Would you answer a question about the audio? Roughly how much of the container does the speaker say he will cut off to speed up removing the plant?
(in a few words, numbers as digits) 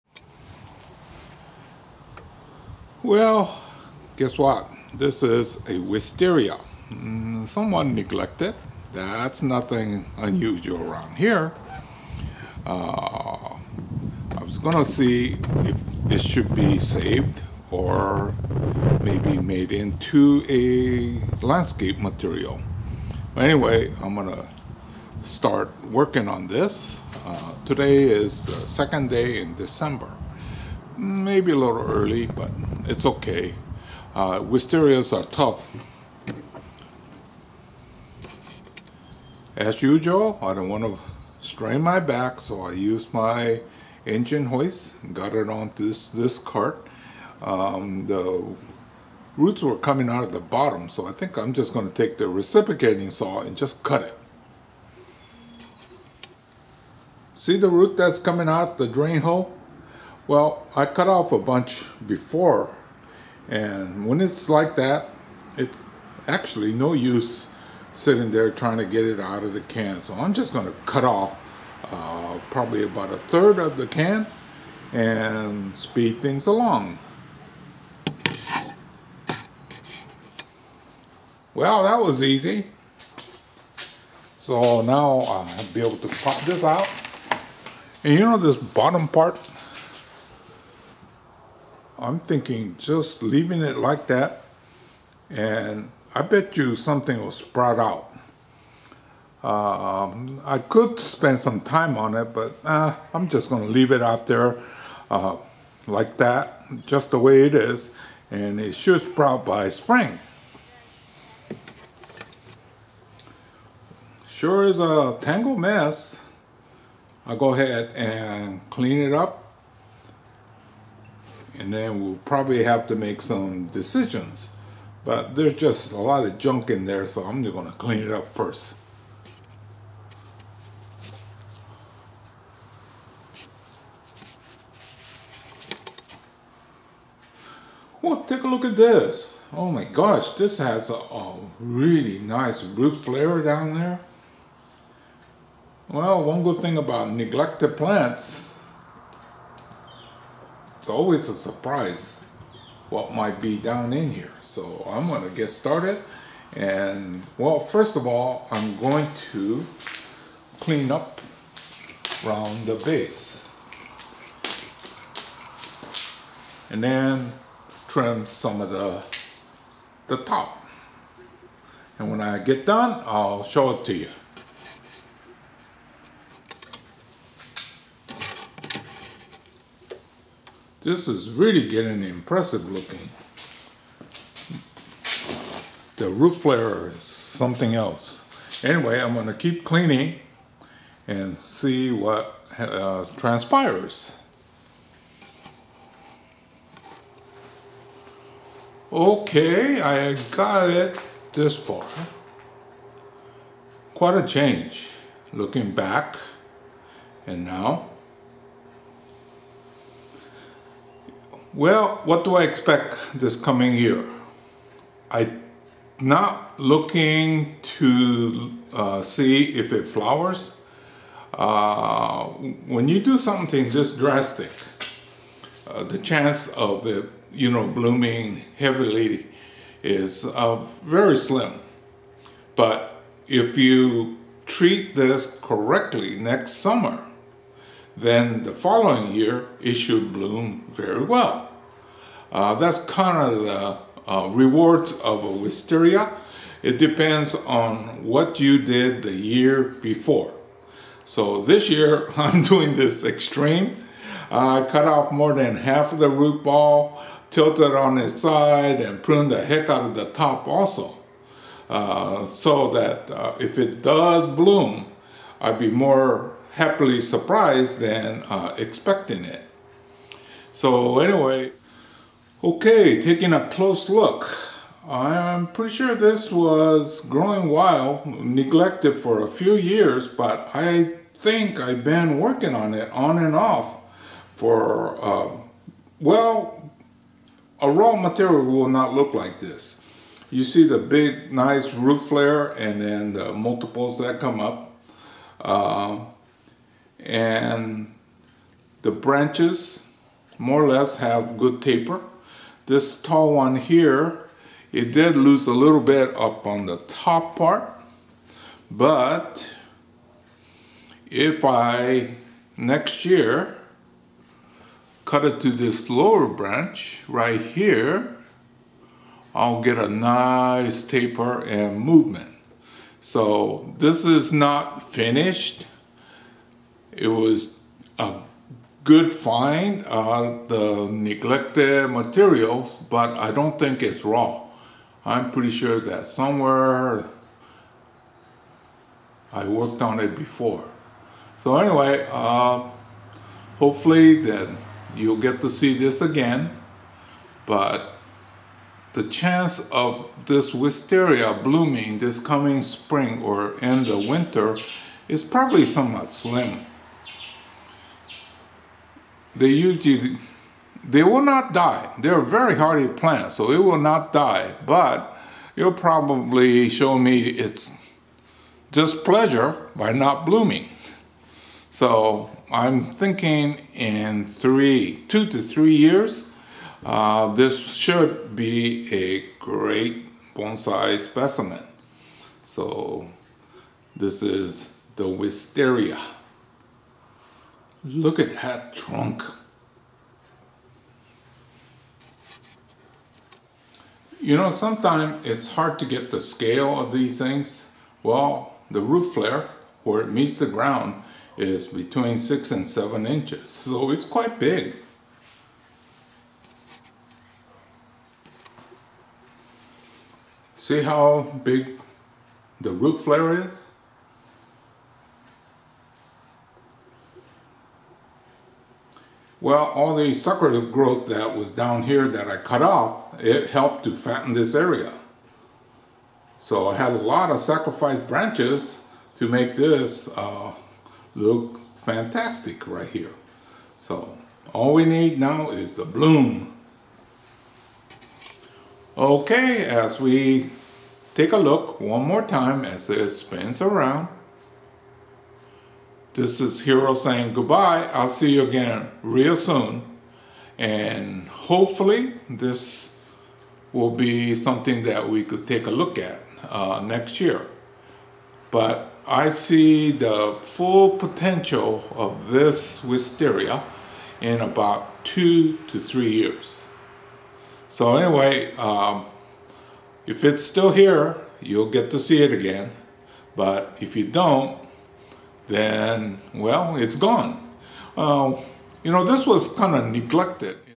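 About a third.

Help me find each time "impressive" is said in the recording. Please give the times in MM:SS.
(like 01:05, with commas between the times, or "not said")
03:02.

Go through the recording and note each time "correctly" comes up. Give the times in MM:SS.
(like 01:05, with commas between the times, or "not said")
03:55.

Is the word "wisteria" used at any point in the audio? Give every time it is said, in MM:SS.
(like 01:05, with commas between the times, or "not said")
00:05, 00:34, 04:05, 05:50, 06:25, 07:42.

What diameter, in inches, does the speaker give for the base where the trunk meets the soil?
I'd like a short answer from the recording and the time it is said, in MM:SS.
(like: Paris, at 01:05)
6 to 7 inches, at 06:41.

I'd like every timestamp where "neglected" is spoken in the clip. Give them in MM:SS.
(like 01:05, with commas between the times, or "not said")
00:07, 02:27, 04:38, 05:30, 07:59.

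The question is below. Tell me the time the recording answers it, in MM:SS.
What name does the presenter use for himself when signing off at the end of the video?
07:26.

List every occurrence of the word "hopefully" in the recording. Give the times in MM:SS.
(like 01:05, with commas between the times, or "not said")
05:43, 07:31.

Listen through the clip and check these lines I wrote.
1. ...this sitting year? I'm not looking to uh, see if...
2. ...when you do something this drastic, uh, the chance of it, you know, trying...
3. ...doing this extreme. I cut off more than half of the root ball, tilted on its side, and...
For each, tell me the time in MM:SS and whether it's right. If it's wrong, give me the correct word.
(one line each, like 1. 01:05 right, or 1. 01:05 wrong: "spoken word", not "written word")
1. 03:33 wrong: "coming", not "sitting"
2. 03:42 wrong: "blooming", not "trying"
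3. 04:12 right.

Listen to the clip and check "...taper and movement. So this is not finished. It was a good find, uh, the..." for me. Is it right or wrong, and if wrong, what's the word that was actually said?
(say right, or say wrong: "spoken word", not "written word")
right.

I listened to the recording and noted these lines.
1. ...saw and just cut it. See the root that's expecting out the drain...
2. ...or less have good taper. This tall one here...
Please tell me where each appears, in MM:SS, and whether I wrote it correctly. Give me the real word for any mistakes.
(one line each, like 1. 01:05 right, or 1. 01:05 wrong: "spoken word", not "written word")
1. 00:53 wrong: "coming", not "expecting"
2. 05:00 right.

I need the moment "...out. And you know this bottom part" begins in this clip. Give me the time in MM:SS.
01:26.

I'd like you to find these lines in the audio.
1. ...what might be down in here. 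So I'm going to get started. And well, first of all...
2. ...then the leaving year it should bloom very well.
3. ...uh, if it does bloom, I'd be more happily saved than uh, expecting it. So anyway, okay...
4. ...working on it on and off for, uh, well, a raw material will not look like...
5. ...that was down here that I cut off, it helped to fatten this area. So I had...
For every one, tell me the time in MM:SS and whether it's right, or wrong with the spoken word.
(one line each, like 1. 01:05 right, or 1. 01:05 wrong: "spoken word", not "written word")
1. 02:32 right
2. 03:58 wrong: "following", not "leaving"
3. 04:23 wrong: "surprised", not "saved"
4. 04:42 right
5. 07:01 right.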